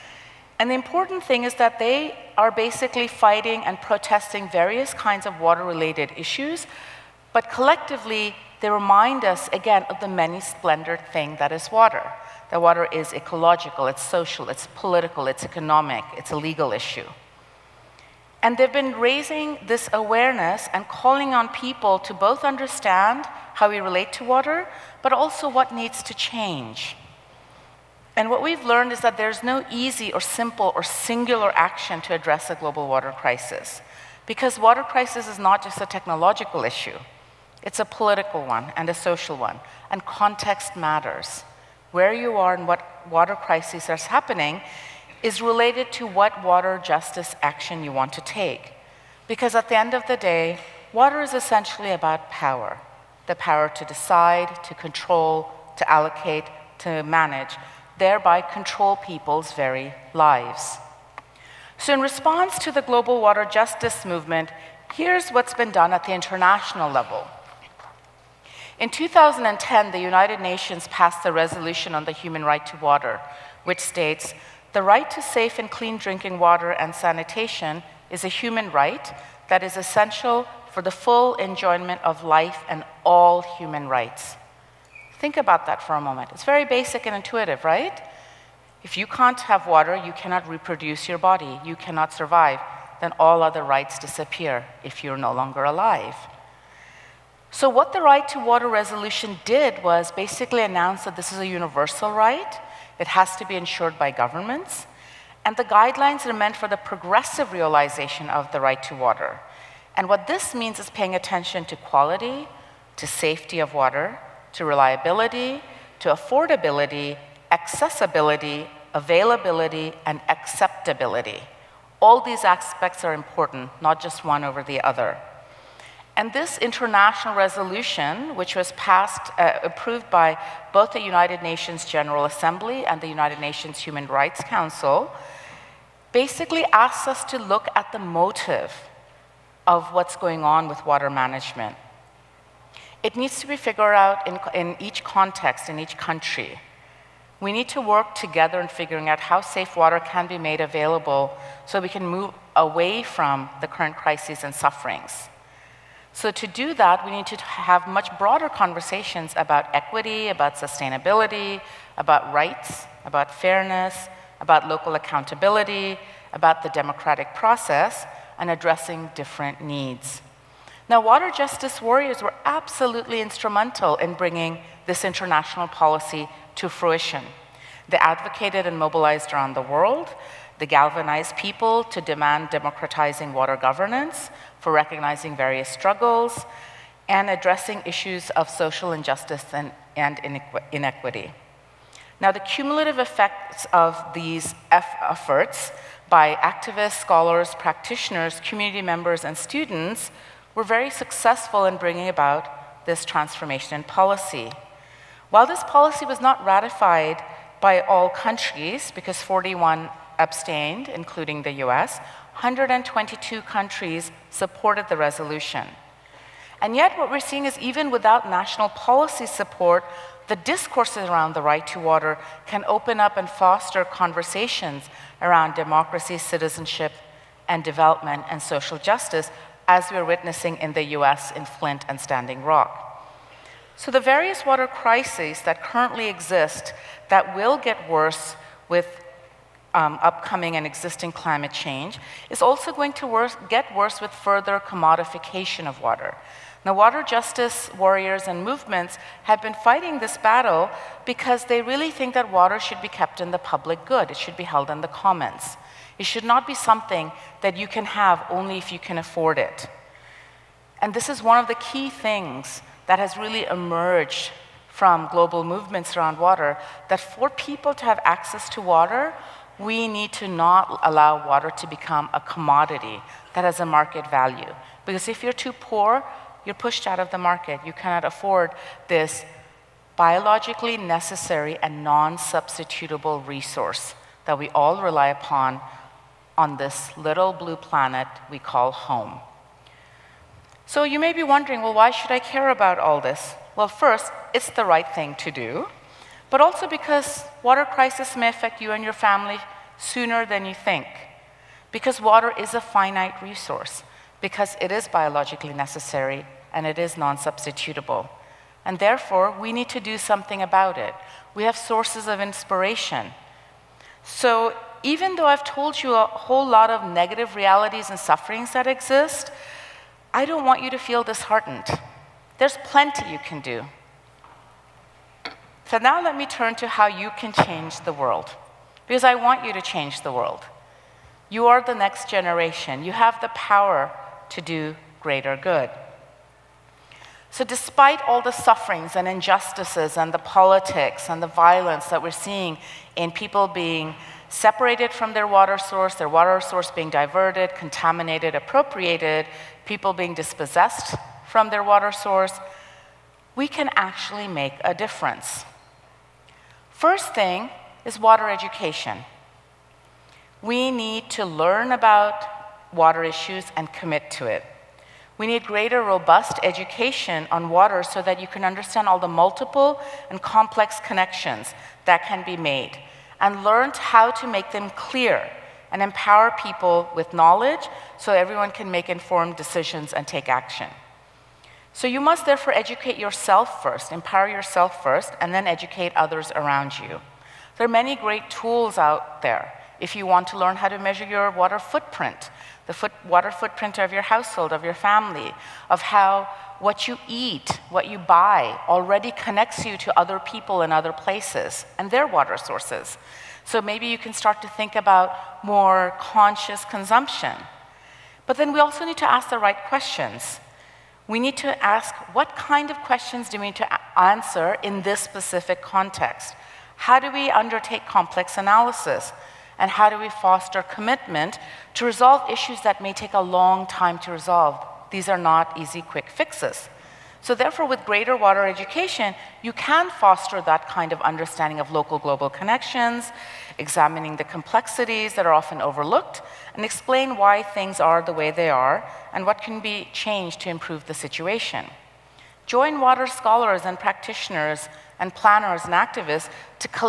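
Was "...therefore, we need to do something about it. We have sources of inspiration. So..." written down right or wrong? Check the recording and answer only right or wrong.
right.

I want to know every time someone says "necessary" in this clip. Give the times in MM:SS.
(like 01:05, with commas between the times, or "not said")
04:40, 05:05.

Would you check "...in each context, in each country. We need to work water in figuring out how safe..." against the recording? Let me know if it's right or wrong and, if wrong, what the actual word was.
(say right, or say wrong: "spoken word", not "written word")
wrong: "together", not "water".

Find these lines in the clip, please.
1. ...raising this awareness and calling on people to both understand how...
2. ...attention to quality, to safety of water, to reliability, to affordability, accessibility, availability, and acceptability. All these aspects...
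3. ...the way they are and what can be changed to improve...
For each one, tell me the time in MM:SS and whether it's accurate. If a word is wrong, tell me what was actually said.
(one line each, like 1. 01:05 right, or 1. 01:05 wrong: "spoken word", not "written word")
1. 00:19 right
2. 01:51 right
3. 07:18 right.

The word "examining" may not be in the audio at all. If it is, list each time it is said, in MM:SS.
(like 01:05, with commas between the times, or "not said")
07:13.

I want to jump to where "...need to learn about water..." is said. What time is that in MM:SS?
06:00.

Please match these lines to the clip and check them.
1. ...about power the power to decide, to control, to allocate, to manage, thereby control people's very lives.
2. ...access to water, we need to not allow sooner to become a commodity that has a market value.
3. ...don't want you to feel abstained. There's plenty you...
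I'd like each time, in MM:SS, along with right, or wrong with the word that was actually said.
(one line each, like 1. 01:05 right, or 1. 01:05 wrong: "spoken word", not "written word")
1. 00:51 right
2. 04:28 wrong: "water", not "sooner"
3. 05:20 wrong: "disheartened", not "abstained".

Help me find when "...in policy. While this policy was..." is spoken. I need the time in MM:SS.
03:23.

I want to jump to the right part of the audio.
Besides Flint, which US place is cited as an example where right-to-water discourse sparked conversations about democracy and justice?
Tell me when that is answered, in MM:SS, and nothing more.
03:52.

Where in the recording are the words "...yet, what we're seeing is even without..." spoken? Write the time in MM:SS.
03:36.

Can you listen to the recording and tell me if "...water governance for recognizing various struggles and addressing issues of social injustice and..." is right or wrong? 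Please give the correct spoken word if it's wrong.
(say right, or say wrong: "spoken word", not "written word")
right.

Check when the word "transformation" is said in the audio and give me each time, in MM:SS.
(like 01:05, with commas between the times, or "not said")
03:23.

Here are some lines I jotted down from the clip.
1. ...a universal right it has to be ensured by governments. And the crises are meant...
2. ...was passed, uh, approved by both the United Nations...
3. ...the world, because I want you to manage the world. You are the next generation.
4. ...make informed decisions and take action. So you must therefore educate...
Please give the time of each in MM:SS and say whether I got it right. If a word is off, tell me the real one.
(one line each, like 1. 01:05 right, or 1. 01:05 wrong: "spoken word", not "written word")
1. 01:41 wrong: "guidelines", not "crises"
2. 02:08 right
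3. 05:27 wrong: "change", not "manage"
4. 06:18 right.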